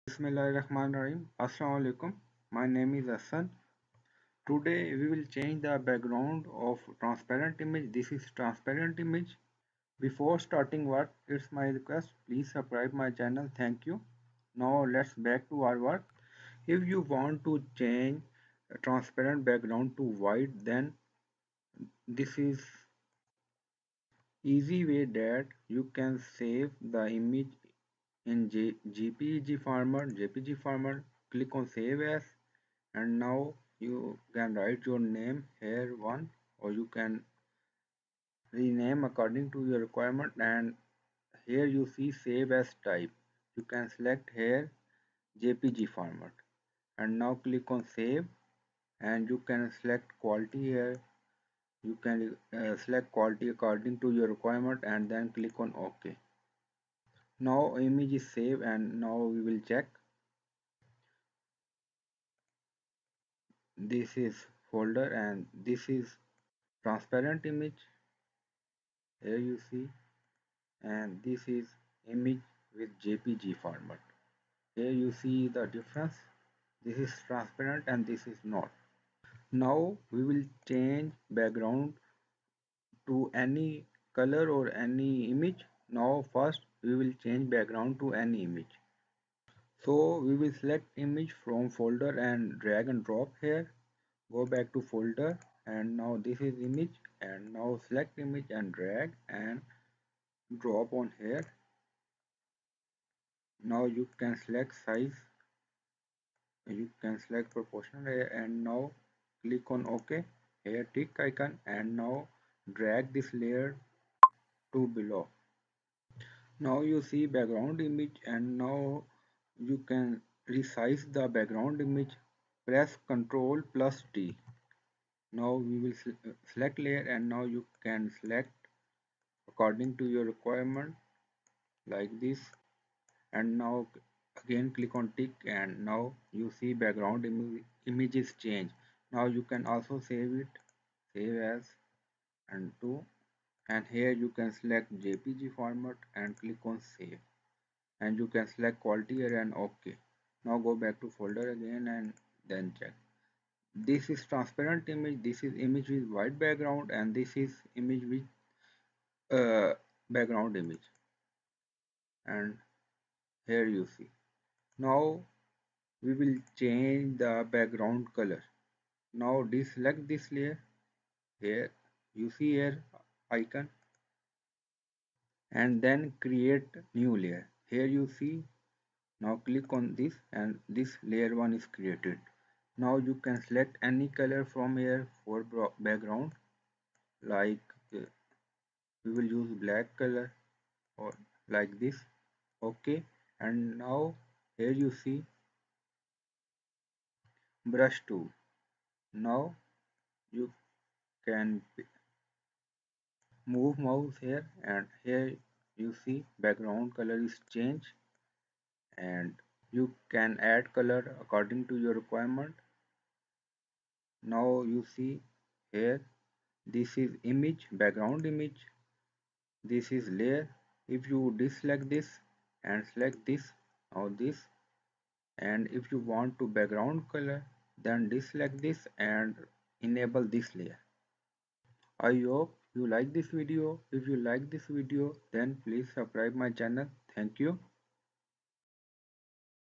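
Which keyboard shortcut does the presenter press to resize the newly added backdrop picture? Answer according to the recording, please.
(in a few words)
ctrl plus t.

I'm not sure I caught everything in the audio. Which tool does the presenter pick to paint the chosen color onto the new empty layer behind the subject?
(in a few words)
brush tool.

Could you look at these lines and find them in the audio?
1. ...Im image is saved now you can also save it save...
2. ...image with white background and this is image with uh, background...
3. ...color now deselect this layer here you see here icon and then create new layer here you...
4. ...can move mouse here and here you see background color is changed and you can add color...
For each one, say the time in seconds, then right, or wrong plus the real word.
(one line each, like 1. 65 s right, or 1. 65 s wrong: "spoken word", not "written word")
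1. 137 s wrong: "changed", not "saved"
2. 155 s right
3. 168 s right
4. 201 s right.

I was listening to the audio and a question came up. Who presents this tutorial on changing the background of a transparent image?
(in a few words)
Hassan.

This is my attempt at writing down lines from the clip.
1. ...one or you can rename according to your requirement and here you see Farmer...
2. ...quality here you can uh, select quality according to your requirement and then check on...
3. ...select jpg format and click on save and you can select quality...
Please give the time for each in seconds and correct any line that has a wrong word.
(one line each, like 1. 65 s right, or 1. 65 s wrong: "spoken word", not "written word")
1. 35 s wrong: "Save", not "Farmer"
2. 50 s wrong: "click", not "check"
3. 144 s right.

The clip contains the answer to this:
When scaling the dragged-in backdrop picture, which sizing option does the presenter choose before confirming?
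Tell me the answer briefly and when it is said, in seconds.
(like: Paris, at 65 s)
proportional, at 107 s.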